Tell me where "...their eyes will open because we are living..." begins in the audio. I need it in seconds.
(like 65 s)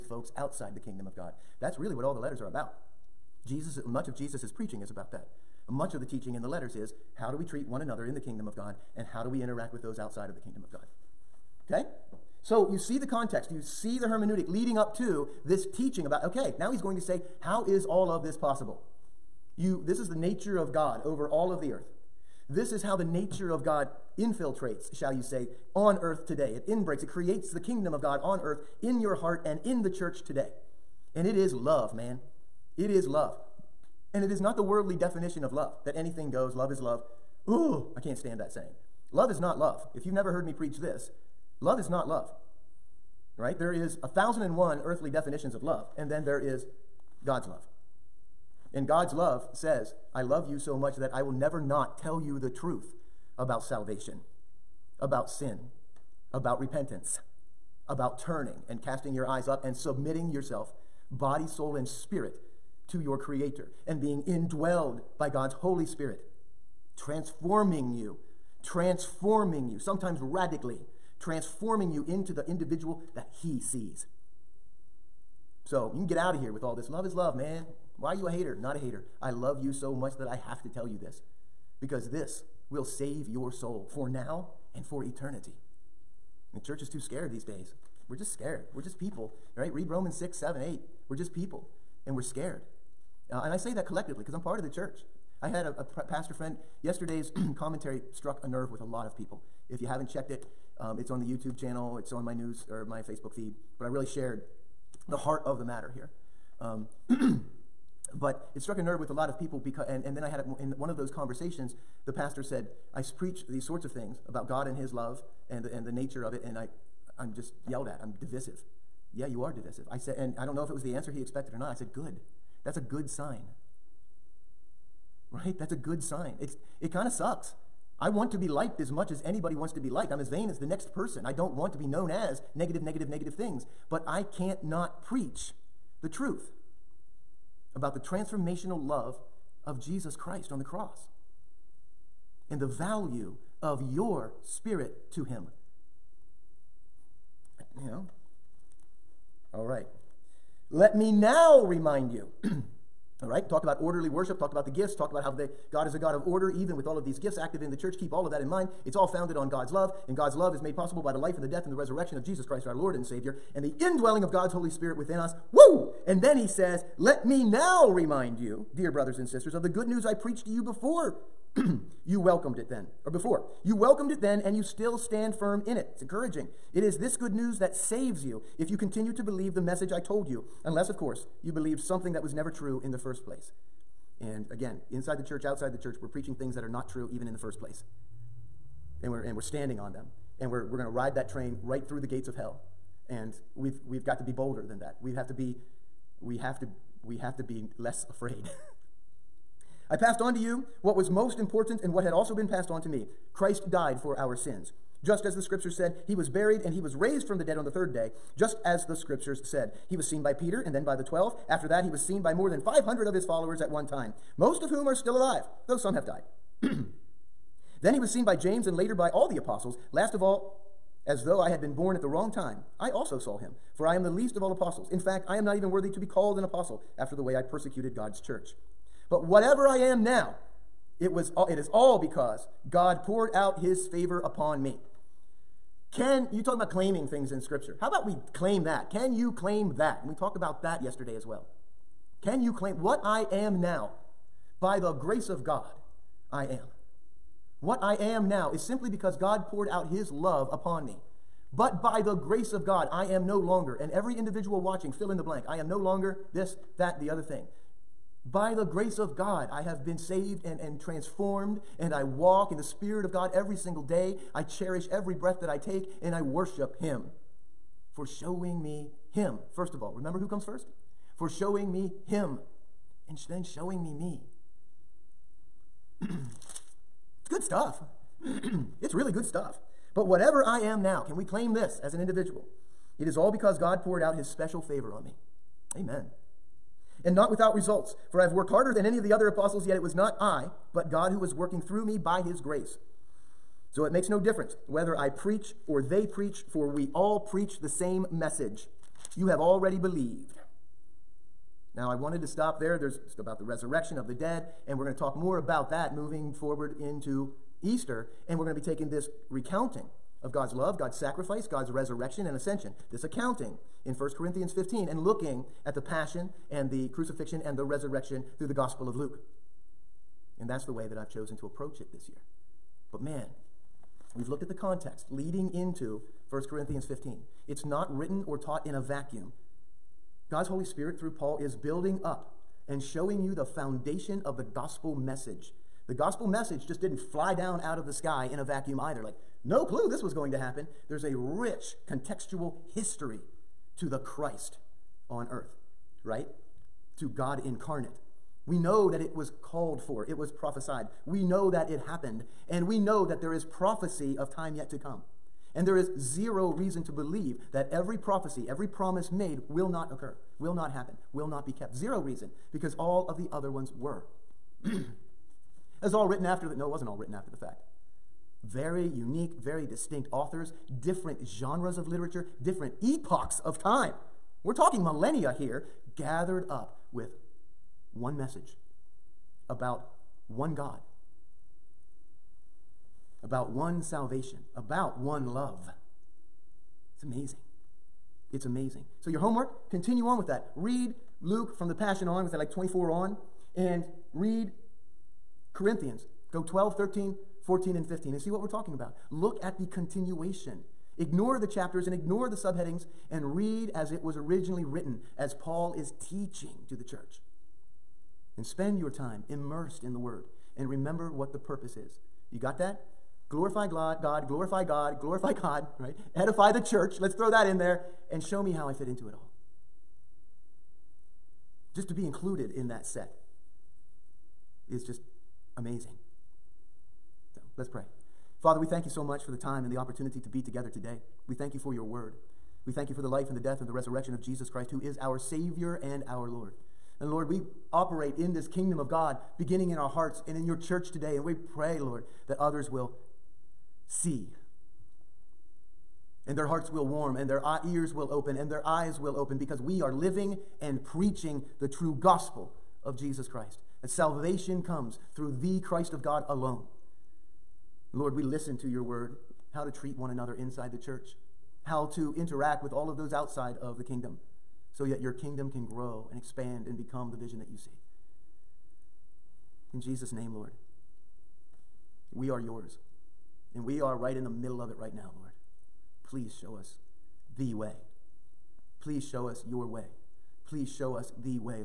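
448 s.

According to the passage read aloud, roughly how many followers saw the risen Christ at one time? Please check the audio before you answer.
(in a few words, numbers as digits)
500.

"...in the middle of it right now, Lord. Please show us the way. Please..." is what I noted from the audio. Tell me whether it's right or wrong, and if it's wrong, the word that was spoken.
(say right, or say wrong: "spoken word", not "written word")
right.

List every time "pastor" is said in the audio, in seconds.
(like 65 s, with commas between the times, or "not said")
96 s, 112 s.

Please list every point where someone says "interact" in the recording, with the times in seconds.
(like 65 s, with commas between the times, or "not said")
9 s, 462 s.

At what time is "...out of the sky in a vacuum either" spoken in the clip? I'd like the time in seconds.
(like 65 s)
337 s.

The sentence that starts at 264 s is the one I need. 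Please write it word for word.
I cherish every breath that I take, and I worship Him for showing me him, first of all.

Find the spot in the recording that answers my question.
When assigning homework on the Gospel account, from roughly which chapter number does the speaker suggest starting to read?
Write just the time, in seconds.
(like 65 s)
392 s.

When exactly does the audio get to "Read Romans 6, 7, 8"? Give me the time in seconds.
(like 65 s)
89 s.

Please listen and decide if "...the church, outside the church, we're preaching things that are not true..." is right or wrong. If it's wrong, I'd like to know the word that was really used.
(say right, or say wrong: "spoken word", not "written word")
right.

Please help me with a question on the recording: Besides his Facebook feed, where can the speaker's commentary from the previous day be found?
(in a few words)
YouTube channel.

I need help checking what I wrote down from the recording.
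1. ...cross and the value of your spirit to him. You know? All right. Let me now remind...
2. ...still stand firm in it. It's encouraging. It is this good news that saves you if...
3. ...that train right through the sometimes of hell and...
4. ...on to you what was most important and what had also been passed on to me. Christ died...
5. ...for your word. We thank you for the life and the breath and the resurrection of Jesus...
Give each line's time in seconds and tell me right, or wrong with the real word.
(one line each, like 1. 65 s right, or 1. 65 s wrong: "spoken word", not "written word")
1. 140 s right
2. 174 s right
3. 191 s wrong: "gates", not "sometimes"
4. 200 s right
5. 431 s wrong: "death", not "breath".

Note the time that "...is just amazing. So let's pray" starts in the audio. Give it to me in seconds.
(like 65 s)
424 s.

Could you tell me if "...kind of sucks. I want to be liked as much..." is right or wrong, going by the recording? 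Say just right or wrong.
right.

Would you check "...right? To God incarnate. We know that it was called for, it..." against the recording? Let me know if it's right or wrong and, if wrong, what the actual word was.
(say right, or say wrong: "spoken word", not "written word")
right.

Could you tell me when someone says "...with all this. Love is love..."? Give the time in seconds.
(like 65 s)
76 s.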